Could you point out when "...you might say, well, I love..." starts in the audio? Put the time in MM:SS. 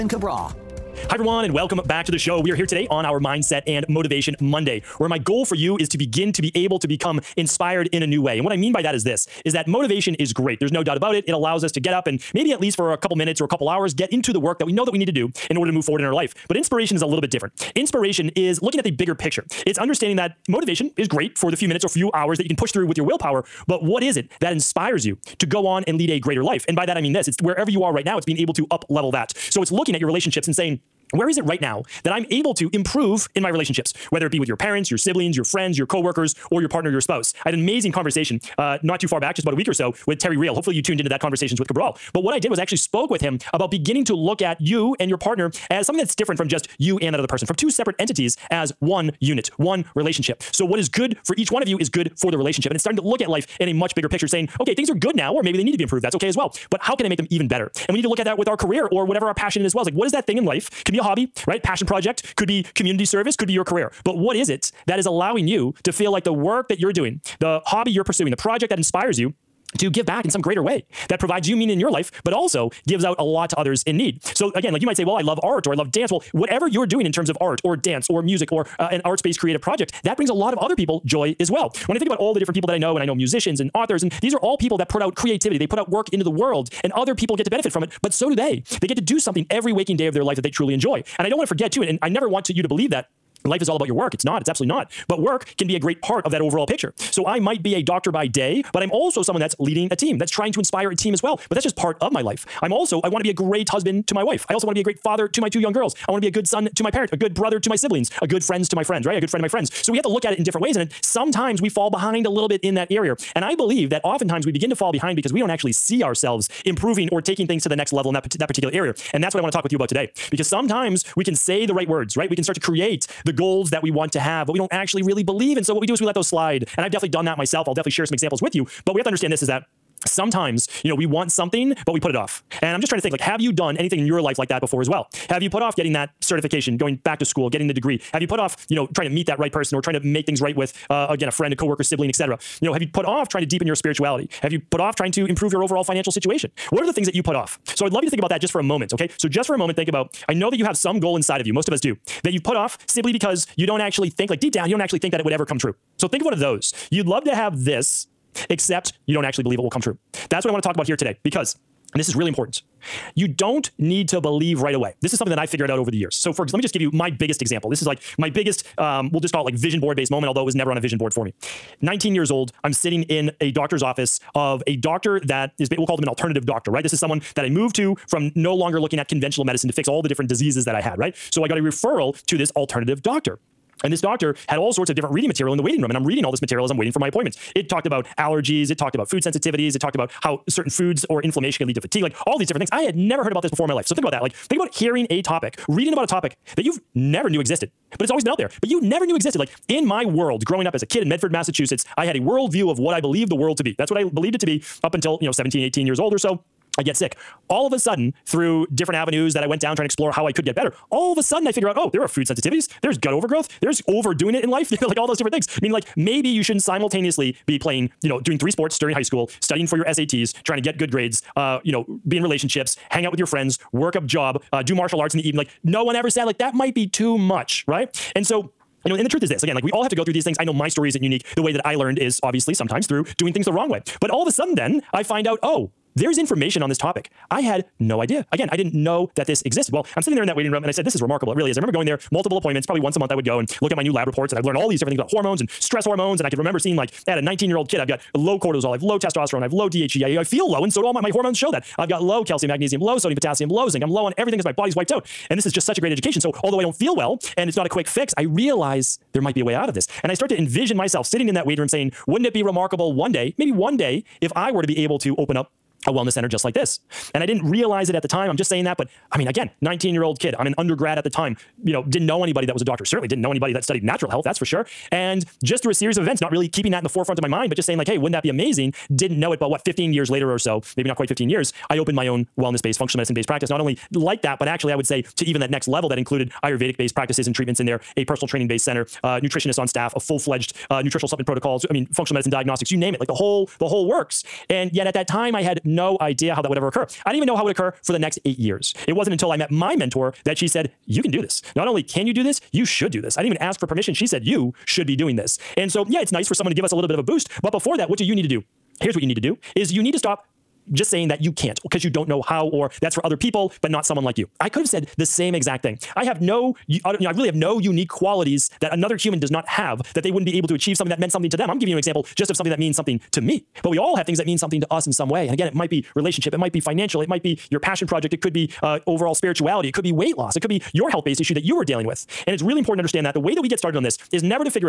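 01:14.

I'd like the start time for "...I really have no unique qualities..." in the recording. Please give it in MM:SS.
05:17.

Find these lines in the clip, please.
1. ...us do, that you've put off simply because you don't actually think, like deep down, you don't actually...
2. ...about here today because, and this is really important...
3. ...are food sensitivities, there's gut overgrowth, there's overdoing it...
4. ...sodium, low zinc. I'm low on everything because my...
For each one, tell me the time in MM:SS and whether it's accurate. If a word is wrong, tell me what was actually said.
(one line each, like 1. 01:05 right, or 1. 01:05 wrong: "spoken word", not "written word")
1. 02:31 right
2. 02:40 right
3. 03:32 right
4. 04:13 wrong: "potassium", not "sodium".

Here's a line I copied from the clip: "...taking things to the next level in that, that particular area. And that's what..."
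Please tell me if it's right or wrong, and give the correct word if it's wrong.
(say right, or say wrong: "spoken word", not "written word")
right.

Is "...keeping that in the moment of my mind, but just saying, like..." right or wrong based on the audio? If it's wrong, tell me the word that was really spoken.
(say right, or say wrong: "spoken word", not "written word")
wrong: "forefront", not "moment".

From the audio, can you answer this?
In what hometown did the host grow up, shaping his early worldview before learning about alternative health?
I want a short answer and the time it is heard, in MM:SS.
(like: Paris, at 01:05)
Medford, Massachusetts, at 03:21.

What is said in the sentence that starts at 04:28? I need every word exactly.
But I mean, again, 19 year old kid.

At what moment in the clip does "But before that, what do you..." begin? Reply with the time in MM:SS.
05:07.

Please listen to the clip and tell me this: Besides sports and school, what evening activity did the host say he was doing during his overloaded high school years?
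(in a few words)
martial arts.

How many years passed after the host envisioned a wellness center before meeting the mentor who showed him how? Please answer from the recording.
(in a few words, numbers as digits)
8 years.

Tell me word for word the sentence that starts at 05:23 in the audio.
But we all have things that mean something to us in some way.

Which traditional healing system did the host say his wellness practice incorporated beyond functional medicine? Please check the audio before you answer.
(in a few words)
Ayurvedic.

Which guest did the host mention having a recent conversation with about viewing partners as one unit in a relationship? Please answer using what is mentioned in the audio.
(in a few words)
Terry Real.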